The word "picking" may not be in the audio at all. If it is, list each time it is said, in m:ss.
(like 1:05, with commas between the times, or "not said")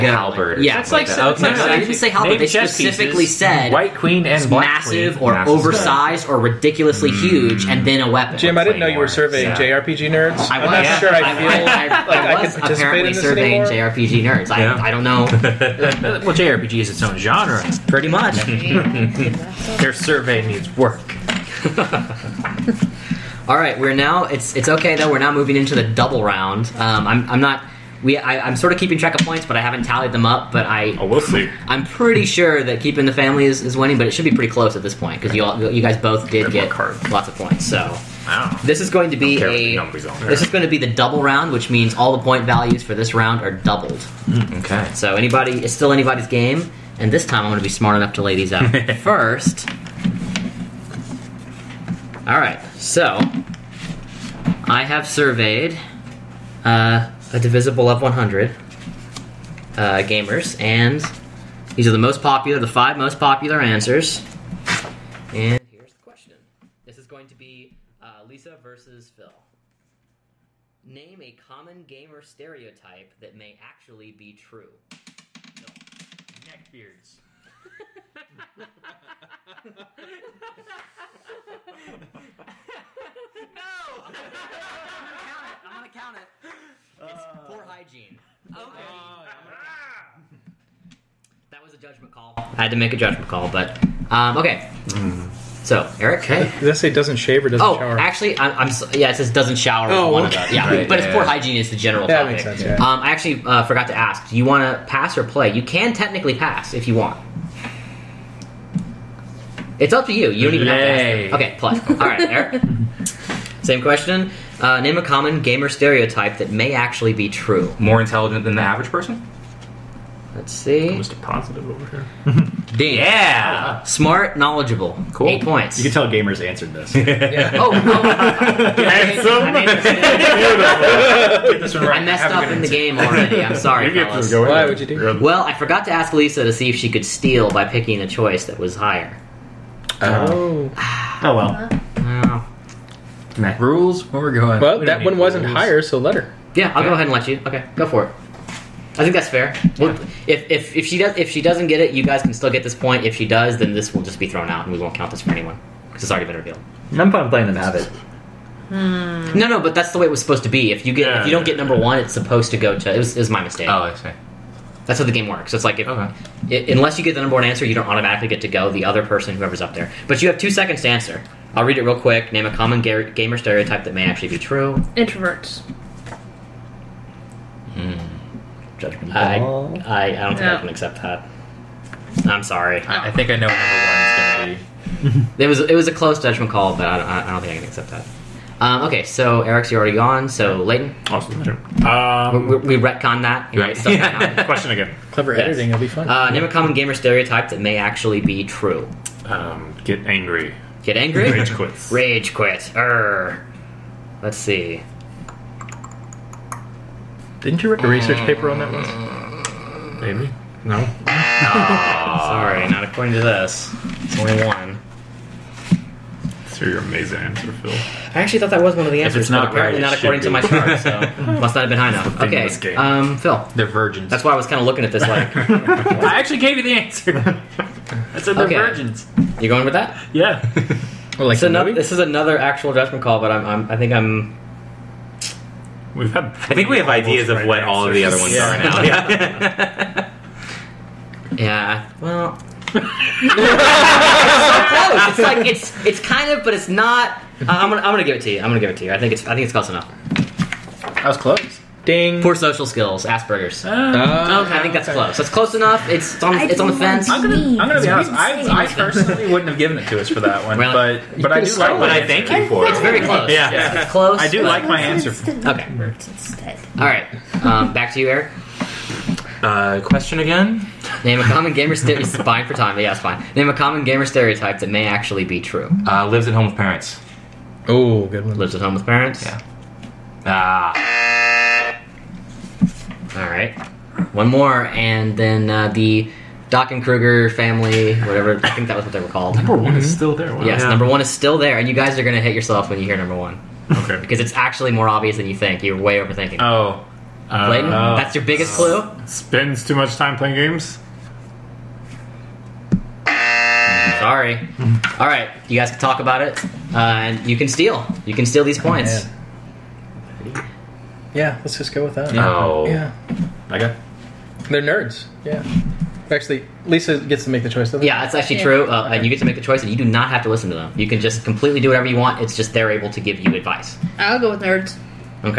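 2:17.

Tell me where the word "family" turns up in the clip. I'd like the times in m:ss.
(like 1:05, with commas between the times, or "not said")
0:33, 4:47.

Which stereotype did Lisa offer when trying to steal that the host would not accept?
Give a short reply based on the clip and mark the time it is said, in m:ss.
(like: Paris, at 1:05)
Introverts, at 2:54.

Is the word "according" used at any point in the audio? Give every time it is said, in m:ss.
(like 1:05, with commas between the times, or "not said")
3:32, 3:39.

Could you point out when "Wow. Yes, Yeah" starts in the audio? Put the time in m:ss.
4:50.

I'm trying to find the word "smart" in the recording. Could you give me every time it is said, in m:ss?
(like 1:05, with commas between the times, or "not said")
0:47, 2:03.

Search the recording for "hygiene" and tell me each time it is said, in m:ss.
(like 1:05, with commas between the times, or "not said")
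1:27, 1:41.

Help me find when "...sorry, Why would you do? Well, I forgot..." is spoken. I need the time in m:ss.
2:13.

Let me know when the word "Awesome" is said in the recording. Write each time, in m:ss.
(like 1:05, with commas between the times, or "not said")
3:11.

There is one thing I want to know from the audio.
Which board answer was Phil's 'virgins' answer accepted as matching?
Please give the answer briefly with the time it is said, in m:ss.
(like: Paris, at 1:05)
Poor social skills, at 4:12.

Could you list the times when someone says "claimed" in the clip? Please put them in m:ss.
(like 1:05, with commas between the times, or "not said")
not said.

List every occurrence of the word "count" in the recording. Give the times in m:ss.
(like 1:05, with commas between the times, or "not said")
1:25, 2:34.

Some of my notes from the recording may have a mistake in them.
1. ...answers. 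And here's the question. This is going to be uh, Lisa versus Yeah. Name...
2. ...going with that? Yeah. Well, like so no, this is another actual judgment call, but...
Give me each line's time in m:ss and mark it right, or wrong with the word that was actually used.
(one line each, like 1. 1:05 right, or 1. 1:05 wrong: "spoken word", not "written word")
1. 1:03 wrong: "Phil", not "Yeah"
2. 3:49 right.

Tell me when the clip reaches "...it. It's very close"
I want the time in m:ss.
4:22.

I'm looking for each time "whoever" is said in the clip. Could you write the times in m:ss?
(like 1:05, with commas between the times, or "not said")
2:49.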